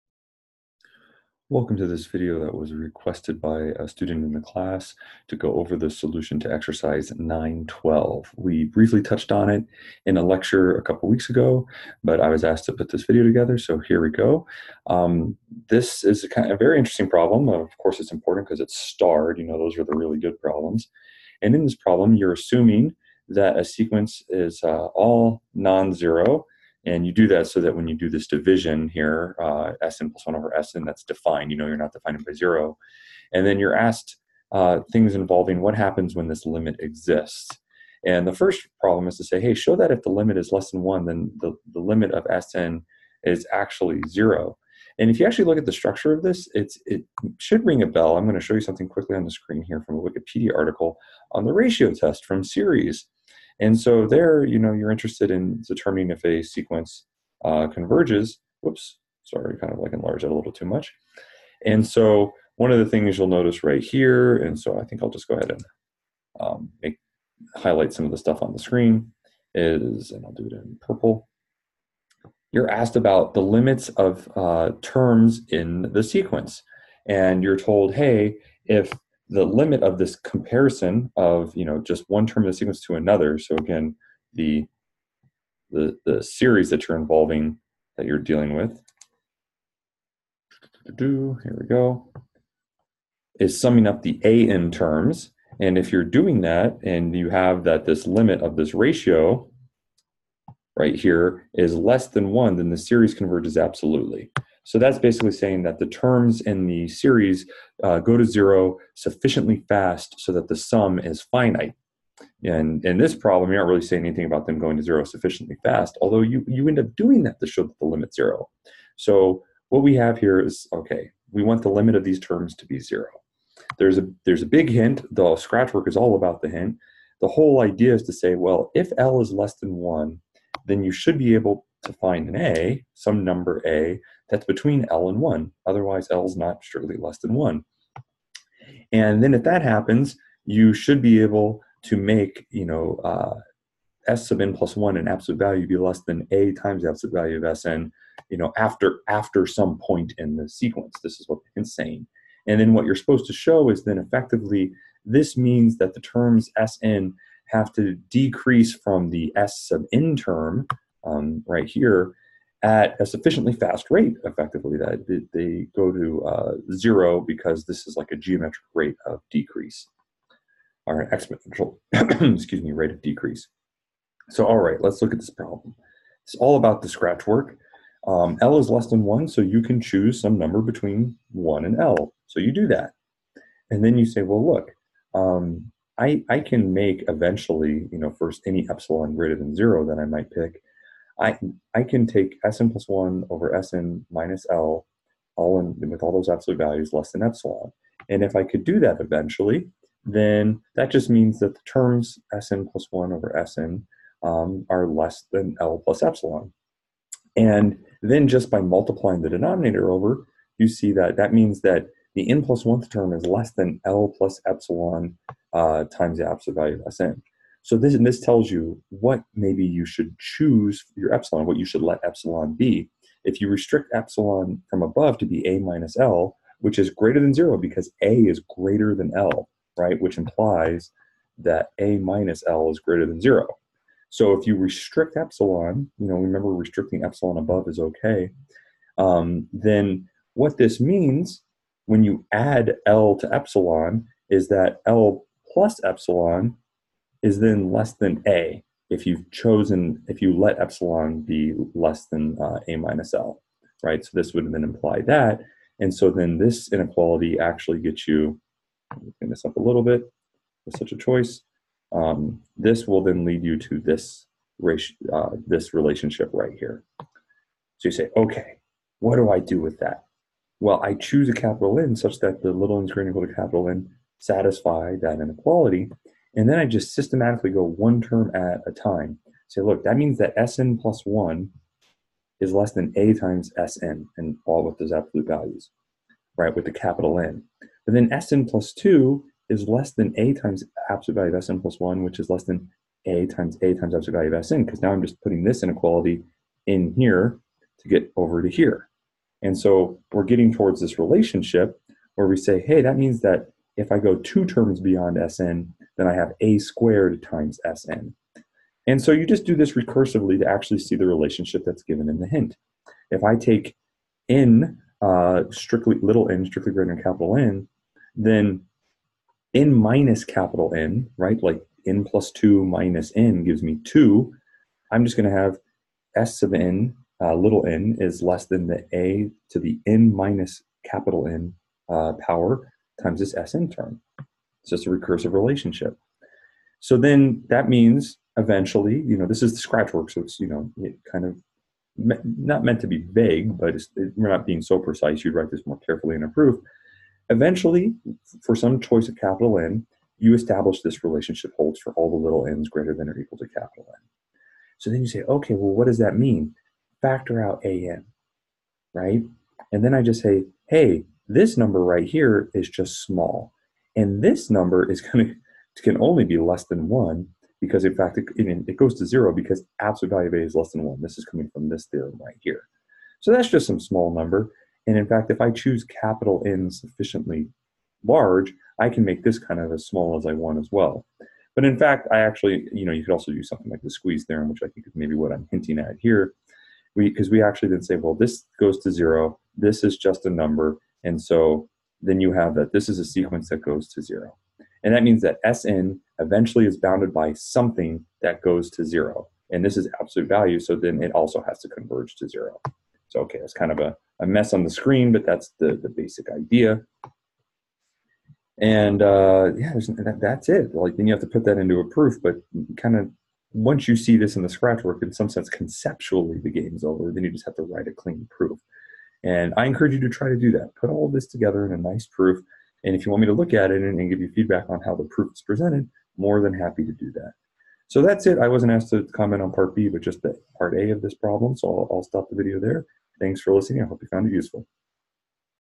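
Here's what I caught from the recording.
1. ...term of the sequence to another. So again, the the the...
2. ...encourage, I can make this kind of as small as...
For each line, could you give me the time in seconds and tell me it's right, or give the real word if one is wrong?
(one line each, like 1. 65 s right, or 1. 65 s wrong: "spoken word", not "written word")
1. 82 s right
2. 378 s wrong: "large", not "encourage".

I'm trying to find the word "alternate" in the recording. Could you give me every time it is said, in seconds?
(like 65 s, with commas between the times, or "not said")
not said.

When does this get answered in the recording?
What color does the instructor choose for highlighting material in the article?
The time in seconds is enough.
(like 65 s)
70 s.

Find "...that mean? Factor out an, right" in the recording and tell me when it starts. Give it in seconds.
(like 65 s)
355 s.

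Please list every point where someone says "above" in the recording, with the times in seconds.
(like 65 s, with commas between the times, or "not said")
224 s, 237 s.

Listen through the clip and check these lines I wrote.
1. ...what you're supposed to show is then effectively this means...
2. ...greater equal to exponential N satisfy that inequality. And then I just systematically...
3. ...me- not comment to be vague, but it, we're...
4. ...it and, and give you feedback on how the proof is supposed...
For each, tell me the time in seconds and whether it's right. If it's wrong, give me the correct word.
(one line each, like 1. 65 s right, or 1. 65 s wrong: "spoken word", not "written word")
1. 152 s right
2. 272 s wrong: "capital", not "exponential"
3. 341 s wrong: "meant", not "comment"
4. 423 s wrong: "presented", not "supposed".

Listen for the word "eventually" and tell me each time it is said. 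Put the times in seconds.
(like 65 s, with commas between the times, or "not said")
187 s, 198 s, 338 s, 347 s, 396 s.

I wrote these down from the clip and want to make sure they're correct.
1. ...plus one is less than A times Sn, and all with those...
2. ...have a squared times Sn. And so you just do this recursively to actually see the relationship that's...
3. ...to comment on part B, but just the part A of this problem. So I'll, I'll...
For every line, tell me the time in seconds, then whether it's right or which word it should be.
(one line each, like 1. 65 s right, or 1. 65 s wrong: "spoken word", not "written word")
1. 280 s right
2. 306 s right
3. 428 s right.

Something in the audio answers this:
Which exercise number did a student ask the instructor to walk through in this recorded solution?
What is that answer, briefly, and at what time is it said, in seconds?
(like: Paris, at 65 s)
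912, at 6 s.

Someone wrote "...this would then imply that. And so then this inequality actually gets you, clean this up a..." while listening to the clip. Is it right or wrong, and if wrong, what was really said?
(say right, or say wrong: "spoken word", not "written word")
right.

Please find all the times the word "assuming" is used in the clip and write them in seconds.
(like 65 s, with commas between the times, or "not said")
22 s.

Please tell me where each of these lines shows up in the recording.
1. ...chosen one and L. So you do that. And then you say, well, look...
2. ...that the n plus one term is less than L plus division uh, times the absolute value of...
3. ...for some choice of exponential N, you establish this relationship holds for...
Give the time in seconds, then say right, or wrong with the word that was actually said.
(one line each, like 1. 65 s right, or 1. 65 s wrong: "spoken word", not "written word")
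1. 180 s wrong: "between", not "chosen"
2. 211 s wrong: "epsilon", not "division"
3. 348 s wrong: "capital", not "exponential".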